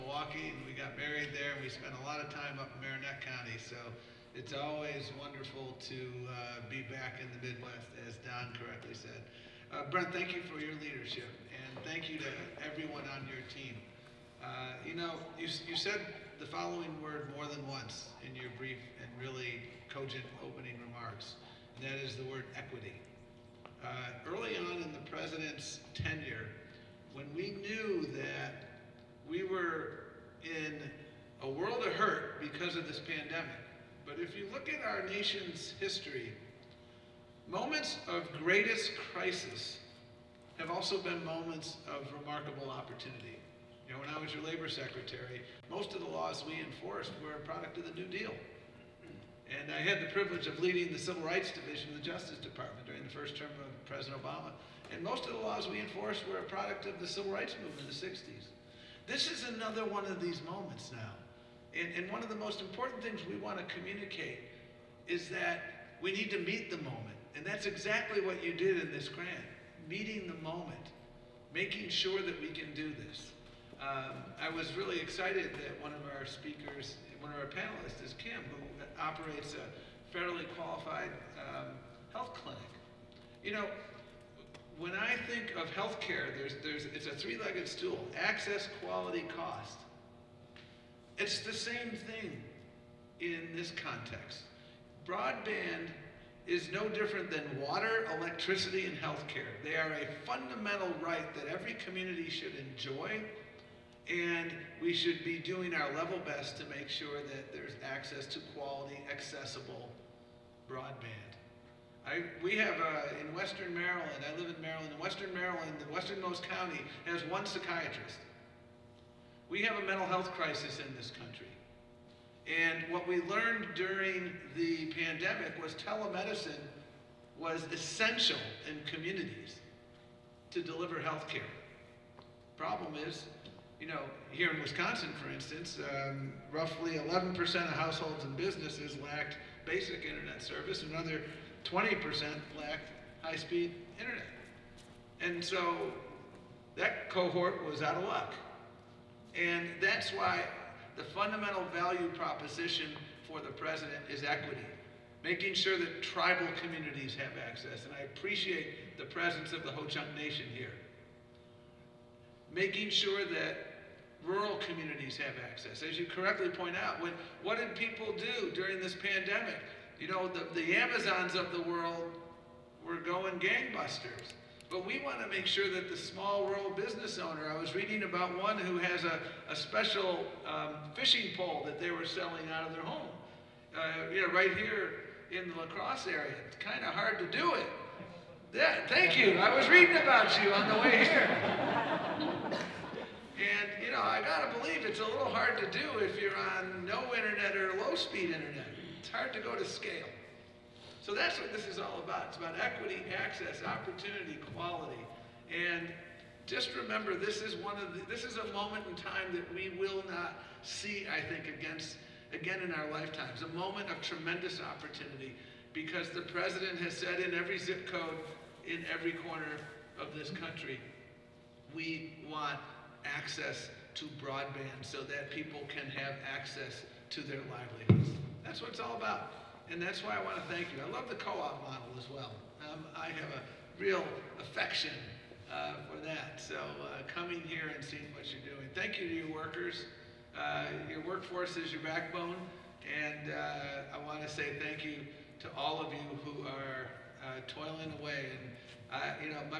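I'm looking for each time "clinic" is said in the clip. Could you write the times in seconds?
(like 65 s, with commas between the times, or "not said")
82 s.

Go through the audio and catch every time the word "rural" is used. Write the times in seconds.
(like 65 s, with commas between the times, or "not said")
164 s, 176 s.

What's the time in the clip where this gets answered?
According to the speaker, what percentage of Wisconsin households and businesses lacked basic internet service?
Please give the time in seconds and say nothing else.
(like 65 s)
136 s.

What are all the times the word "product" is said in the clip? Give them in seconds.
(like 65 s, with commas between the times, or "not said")
47 s, 56 s.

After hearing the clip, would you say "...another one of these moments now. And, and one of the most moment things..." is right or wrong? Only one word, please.
wrong.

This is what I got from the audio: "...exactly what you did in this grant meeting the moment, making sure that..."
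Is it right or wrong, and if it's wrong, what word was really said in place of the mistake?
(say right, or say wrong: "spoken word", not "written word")
right.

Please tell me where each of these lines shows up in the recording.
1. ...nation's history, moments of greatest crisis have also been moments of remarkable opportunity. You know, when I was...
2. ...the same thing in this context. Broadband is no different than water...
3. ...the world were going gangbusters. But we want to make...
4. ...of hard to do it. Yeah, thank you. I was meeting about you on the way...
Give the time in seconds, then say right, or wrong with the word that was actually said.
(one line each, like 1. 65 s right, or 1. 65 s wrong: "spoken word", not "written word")
1. 35 s right
2. 91 s right
3. 171 s right
4. 186 s wrong: "reading", not "meeting".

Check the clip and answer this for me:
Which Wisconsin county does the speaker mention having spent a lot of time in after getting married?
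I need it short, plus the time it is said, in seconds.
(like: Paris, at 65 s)
Marinette County, at 2 s.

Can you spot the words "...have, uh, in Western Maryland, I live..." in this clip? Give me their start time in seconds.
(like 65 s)
112 s.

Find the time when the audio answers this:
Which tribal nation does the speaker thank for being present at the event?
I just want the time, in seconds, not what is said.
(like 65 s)
159 s.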